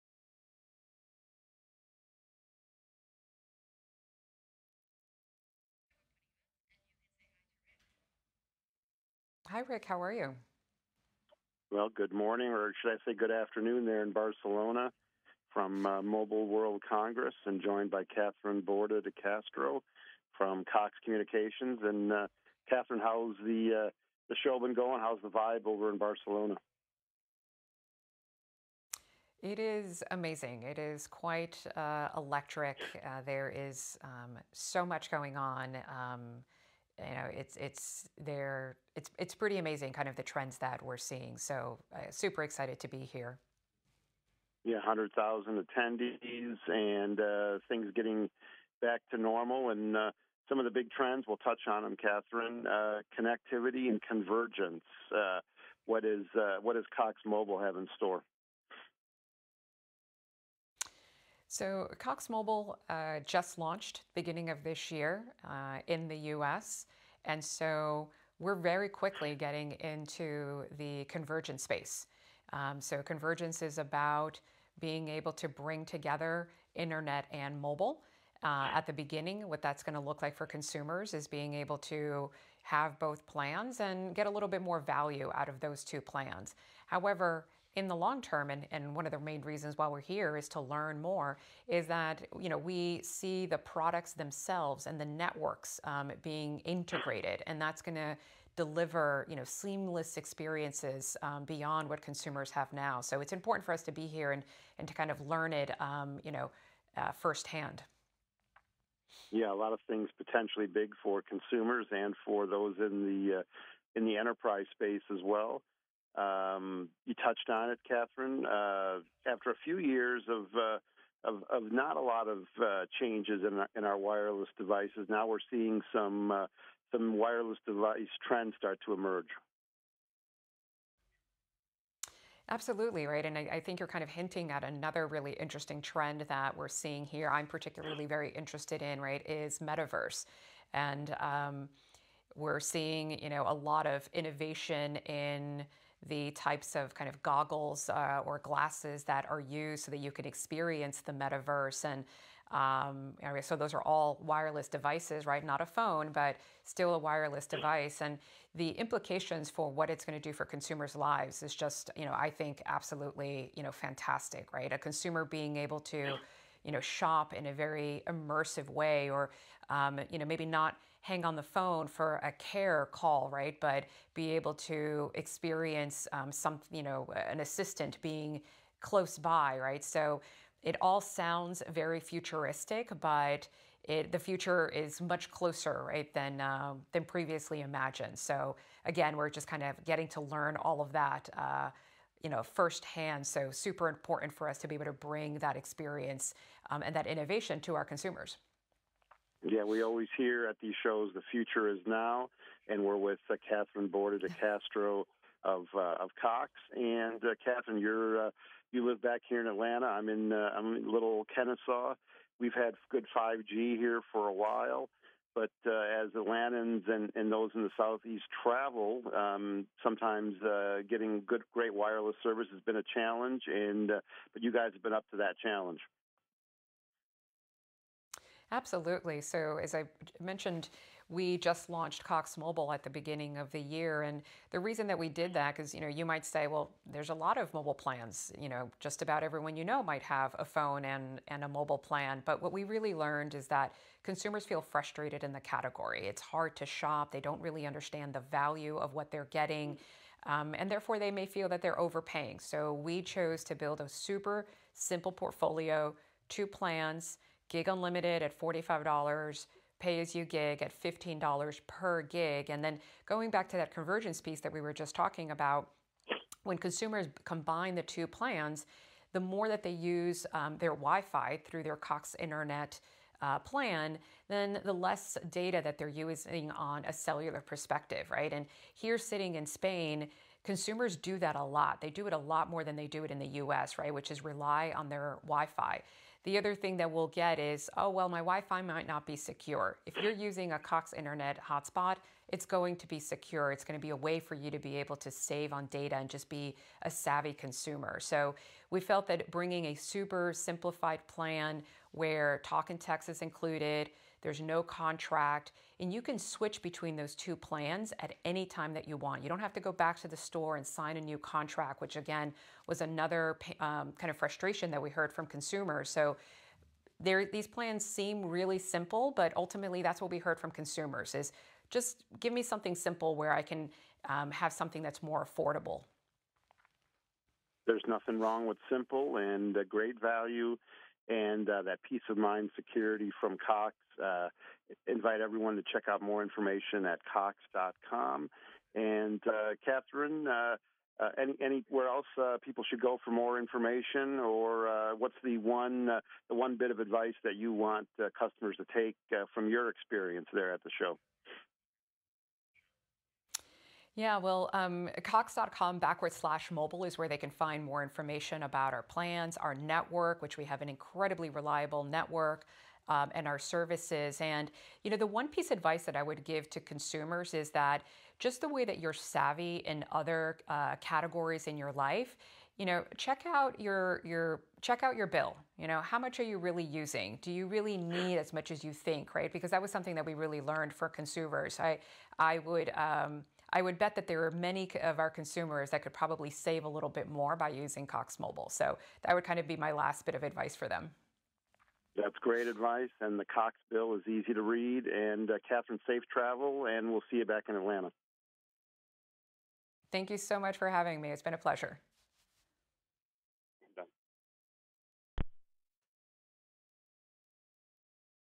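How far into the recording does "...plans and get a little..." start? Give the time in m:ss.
1:23.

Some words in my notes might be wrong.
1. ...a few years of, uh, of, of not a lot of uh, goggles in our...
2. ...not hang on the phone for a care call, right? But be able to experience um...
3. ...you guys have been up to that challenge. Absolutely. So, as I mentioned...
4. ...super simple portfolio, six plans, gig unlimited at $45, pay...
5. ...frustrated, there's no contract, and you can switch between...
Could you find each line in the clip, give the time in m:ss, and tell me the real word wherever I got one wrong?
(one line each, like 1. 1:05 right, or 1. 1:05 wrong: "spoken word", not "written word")
1. 1:59 wrong: "changes", not "goggles"
2. 2:50 right
3. 3:44 right
4. 4:13 wrong: "two", not "six"
5. 5:03 wrong: "included", not "frustrated".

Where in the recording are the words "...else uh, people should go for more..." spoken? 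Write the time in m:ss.
5:41.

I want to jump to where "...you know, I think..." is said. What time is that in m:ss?
2:41.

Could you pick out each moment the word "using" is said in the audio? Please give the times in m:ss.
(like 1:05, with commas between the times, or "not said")
4:35, 4:50, 6:16, 6:27.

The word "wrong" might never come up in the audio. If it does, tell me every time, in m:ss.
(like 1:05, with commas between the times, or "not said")
5:28.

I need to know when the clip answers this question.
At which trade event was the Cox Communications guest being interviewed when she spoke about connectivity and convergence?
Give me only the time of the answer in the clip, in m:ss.
0:16.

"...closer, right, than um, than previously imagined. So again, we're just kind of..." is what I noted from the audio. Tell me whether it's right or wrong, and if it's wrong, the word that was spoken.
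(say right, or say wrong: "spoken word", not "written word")
right.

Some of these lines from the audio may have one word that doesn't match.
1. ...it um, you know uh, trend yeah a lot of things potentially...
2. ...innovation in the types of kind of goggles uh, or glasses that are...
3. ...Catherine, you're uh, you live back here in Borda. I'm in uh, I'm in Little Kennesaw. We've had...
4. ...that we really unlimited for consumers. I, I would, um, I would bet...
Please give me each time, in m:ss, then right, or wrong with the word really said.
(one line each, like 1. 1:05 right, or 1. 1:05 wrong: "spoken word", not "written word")
1. 1:45 wrong: "firsthand", not "trend"
2. 2:24 right
3. 3:27 wrong: "Atlanta", not "Borda"
4. 6:19 wrong: "learned", not "unlimited".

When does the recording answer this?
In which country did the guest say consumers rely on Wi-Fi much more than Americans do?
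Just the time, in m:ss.
4:39.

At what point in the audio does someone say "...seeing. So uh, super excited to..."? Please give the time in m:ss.
0:40.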